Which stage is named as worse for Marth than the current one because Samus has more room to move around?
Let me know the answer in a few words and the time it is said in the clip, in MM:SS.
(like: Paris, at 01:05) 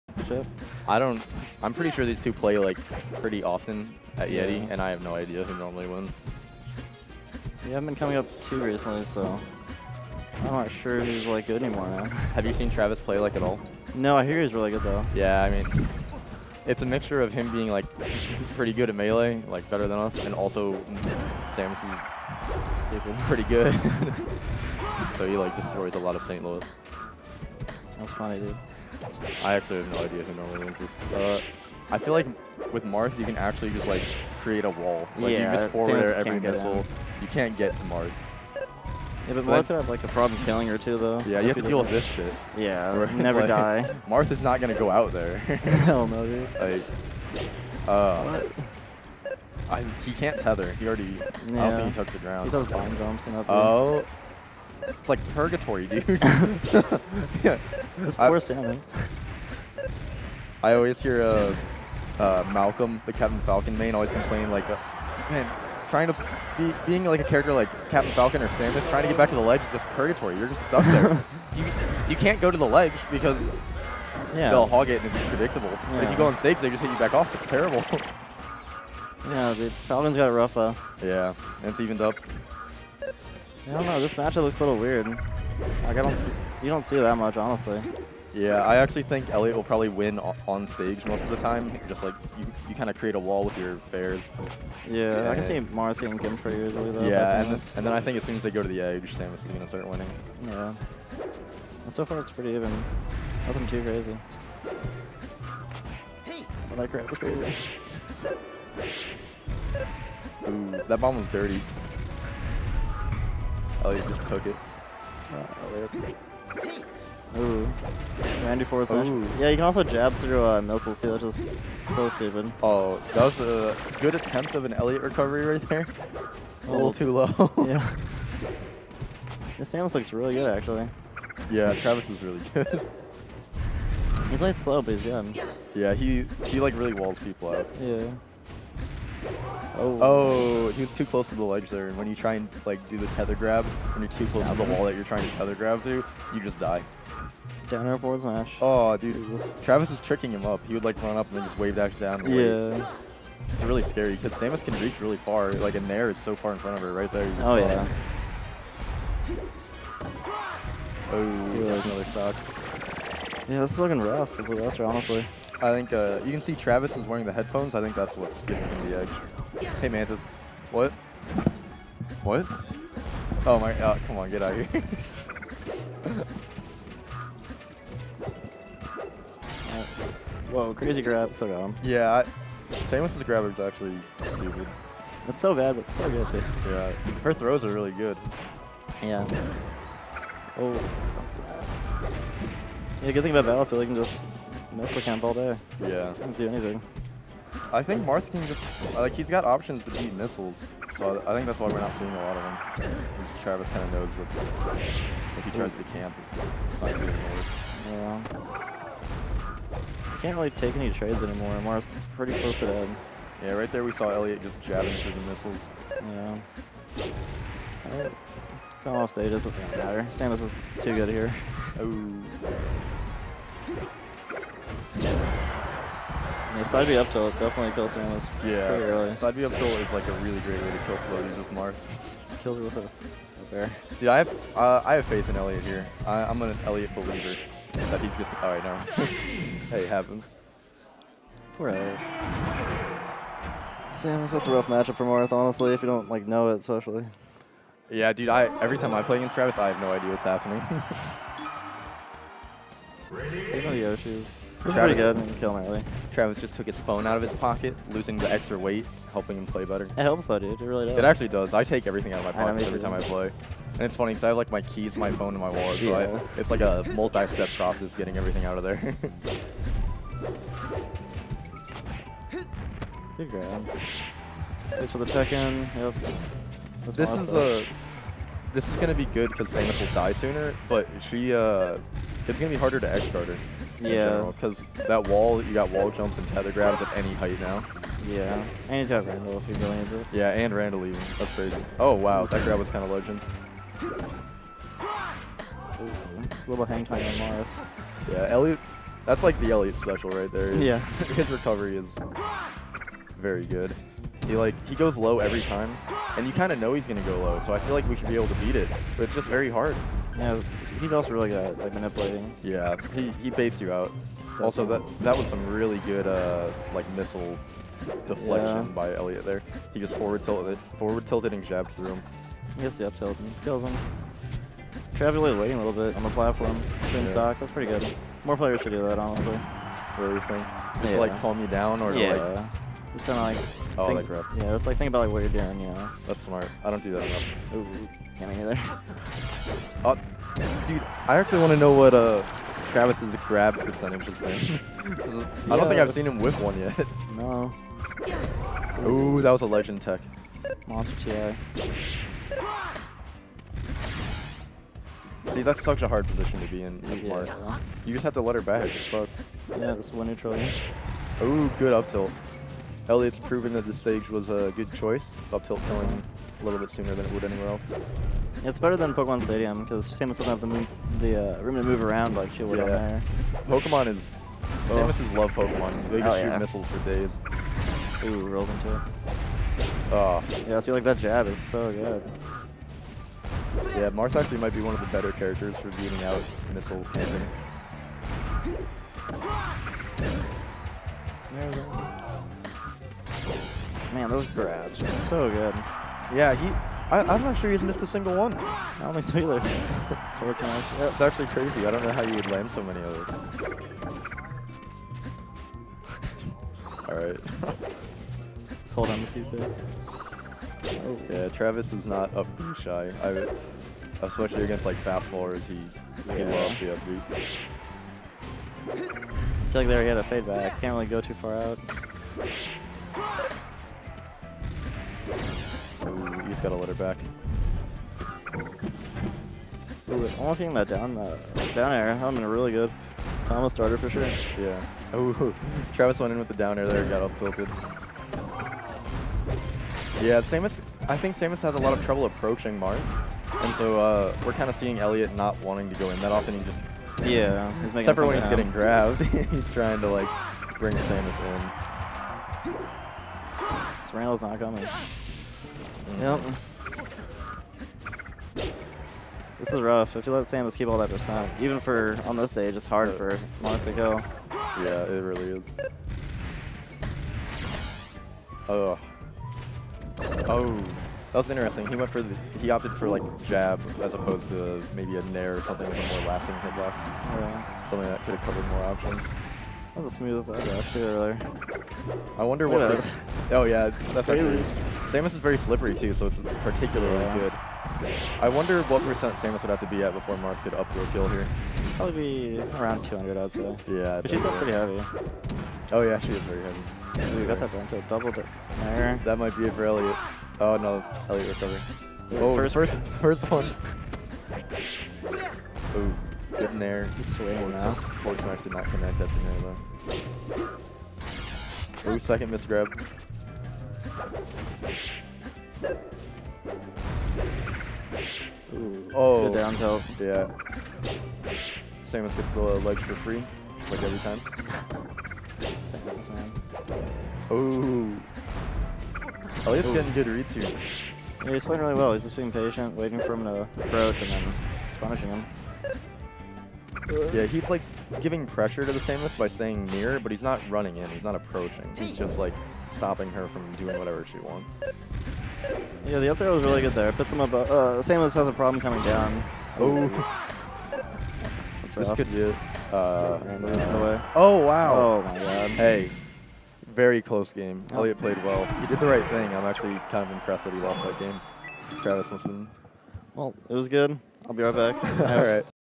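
Pokemon Stadium, at 06:08.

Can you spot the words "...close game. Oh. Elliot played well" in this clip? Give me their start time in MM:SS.
09:17.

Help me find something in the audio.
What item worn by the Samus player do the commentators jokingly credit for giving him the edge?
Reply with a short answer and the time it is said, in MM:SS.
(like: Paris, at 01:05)
headphones, at 02:47.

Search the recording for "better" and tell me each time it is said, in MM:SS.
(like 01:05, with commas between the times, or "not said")
00:19, 04:19, 06:08, 06:24.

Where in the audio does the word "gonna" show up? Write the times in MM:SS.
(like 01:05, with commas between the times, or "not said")
00:44, 01:39, 04:38, 05:06.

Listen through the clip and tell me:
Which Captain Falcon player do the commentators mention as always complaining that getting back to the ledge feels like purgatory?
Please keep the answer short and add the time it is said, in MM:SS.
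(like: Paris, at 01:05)
Malcolm, at 01:02.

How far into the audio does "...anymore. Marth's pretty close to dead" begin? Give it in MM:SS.
03:31.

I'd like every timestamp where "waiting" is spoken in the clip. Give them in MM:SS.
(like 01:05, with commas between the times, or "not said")
05:25, 08:52.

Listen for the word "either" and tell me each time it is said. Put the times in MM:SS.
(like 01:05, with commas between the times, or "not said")
05:38, 06:39.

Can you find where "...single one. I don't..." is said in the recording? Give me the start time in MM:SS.
06:37.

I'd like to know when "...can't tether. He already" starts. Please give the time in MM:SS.
00:50.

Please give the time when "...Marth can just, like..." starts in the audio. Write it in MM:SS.
03:18.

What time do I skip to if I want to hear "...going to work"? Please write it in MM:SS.
03:26.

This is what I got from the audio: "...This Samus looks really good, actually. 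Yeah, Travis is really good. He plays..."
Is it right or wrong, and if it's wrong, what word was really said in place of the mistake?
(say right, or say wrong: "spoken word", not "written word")
right.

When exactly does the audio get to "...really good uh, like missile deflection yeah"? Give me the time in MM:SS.
05:15.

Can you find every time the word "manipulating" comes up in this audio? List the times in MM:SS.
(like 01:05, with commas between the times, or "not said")
05:11.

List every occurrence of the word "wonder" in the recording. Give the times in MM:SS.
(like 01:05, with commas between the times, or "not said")
08:02, 08:08.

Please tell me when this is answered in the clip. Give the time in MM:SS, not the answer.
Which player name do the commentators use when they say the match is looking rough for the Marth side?
02:44.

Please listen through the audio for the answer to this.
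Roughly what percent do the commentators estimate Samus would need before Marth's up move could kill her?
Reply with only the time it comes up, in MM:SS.
08:12.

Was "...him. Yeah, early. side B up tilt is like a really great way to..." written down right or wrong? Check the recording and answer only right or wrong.
right.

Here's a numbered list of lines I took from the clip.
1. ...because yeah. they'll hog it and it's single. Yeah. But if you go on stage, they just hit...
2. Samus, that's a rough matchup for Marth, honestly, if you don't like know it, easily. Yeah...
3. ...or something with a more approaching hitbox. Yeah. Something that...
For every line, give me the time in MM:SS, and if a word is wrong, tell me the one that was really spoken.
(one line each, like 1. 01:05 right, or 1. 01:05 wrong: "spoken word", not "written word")
1. 01:13 wrong: "predictable", not "single"
2. 04:03 wrong: "especially", not "easily"
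3. 07:55 wrong: "lasting", not "approaching".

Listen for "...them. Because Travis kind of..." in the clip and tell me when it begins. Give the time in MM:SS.
03:22.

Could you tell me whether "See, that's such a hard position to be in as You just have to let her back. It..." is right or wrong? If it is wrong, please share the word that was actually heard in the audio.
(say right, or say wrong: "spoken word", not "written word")
right.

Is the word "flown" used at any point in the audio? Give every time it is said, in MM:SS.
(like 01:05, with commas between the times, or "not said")
not said.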